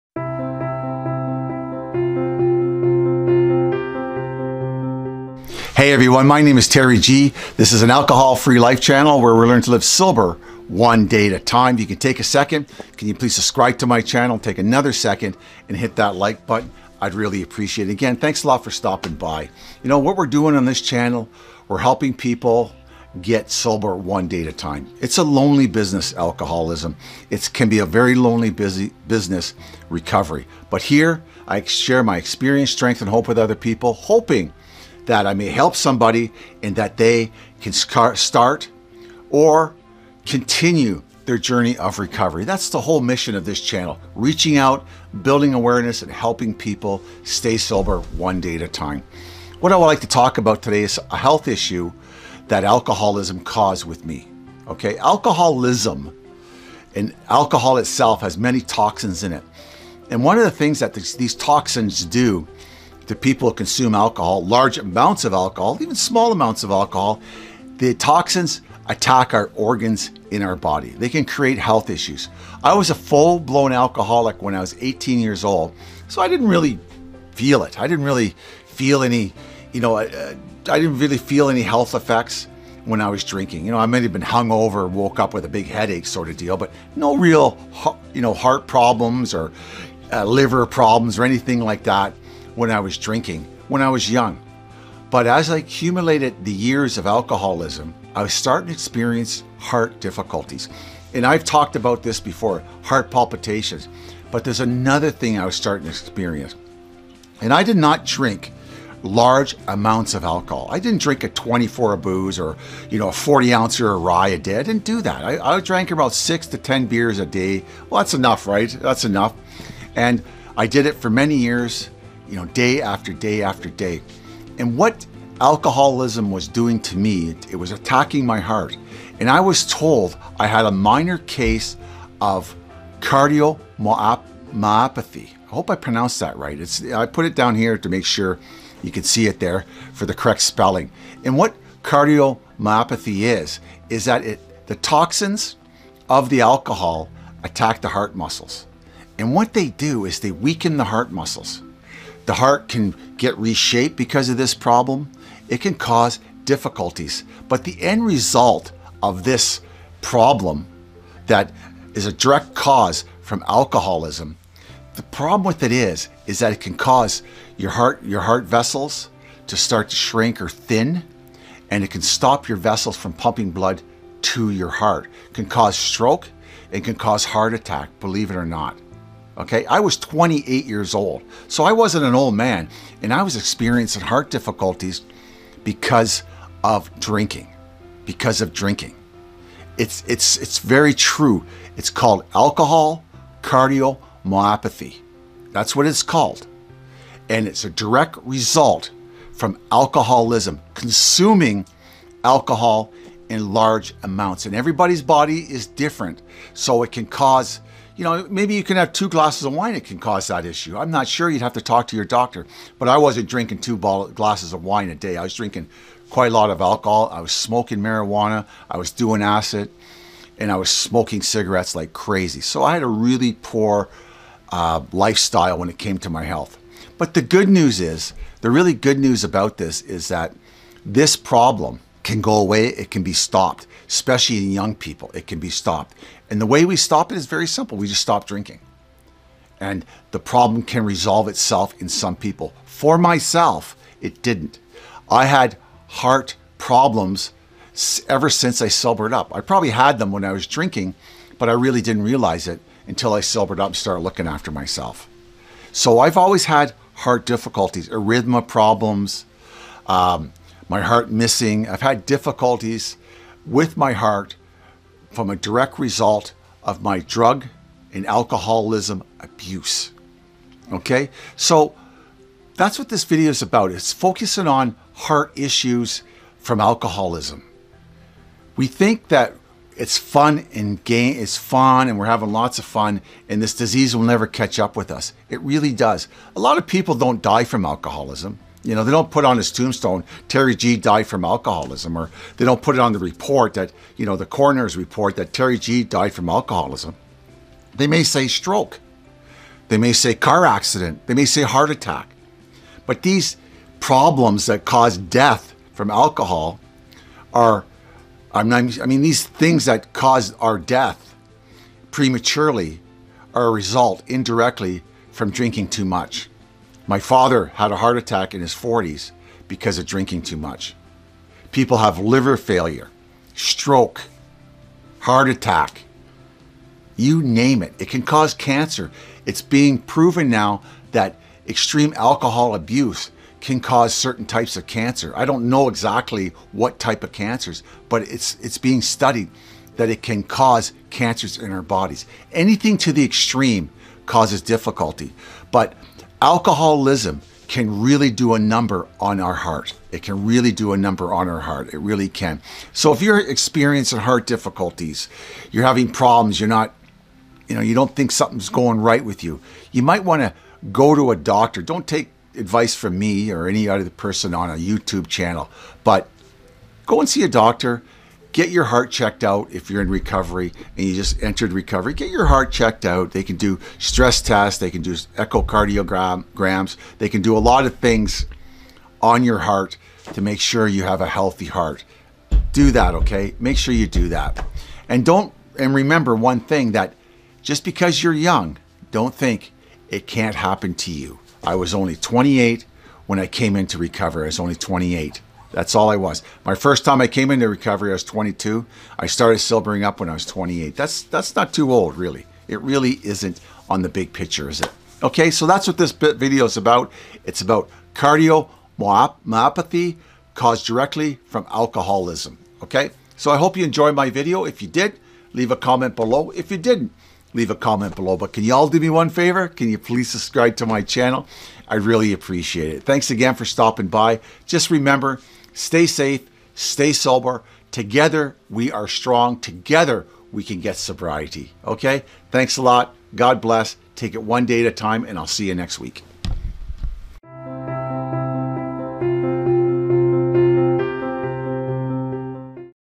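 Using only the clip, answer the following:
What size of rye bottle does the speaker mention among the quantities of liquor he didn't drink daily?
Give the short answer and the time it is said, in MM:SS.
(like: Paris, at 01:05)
40 ouncer, at 01:53.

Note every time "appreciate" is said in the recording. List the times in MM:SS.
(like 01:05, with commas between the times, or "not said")
00:17, 07:02.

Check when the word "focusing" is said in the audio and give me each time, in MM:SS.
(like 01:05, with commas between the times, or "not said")
04:33.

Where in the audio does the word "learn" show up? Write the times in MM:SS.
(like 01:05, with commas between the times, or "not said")
00:09.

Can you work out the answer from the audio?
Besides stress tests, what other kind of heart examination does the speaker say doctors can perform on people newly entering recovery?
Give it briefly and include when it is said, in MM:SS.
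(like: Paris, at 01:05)
echocardiograms, at 06:14.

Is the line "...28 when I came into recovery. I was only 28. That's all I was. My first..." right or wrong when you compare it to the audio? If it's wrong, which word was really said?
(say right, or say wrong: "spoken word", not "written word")
right.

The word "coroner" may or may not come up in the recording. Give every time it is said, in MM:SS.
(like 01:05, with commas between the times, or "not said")
04:54.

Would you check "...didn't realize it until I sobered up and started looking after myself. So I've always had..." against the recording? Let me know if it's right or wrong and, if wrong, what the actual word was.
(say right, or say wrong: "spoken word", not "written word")
right.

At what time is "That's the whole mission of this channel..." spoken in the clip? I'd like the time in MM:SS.
00:42.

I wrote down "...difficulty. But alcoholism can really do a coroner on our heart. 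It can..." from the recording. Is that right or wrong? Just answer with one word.
wrong.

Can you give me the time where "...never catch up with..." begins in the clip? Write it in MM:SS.
04:44.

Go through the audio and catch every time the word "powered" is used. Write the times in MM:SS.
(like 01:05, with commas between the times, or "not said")
not said.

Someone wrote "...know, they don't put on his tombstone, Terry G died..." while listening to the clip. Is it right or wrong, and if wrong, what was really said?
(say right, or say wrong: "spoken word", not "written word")
right.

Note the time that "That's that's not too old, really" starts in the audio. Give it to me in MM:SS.
06:40.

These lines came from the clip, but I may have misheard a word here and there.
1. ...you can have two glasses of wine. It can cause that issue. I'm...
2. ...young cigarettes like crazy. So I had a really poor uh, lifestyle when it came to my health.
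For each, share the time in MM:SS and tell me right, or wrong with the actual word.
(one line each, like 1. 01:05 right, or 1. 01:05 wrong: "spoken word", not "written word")
1. 03:28 right
2. 03:40 wrong: "smoking", not "young".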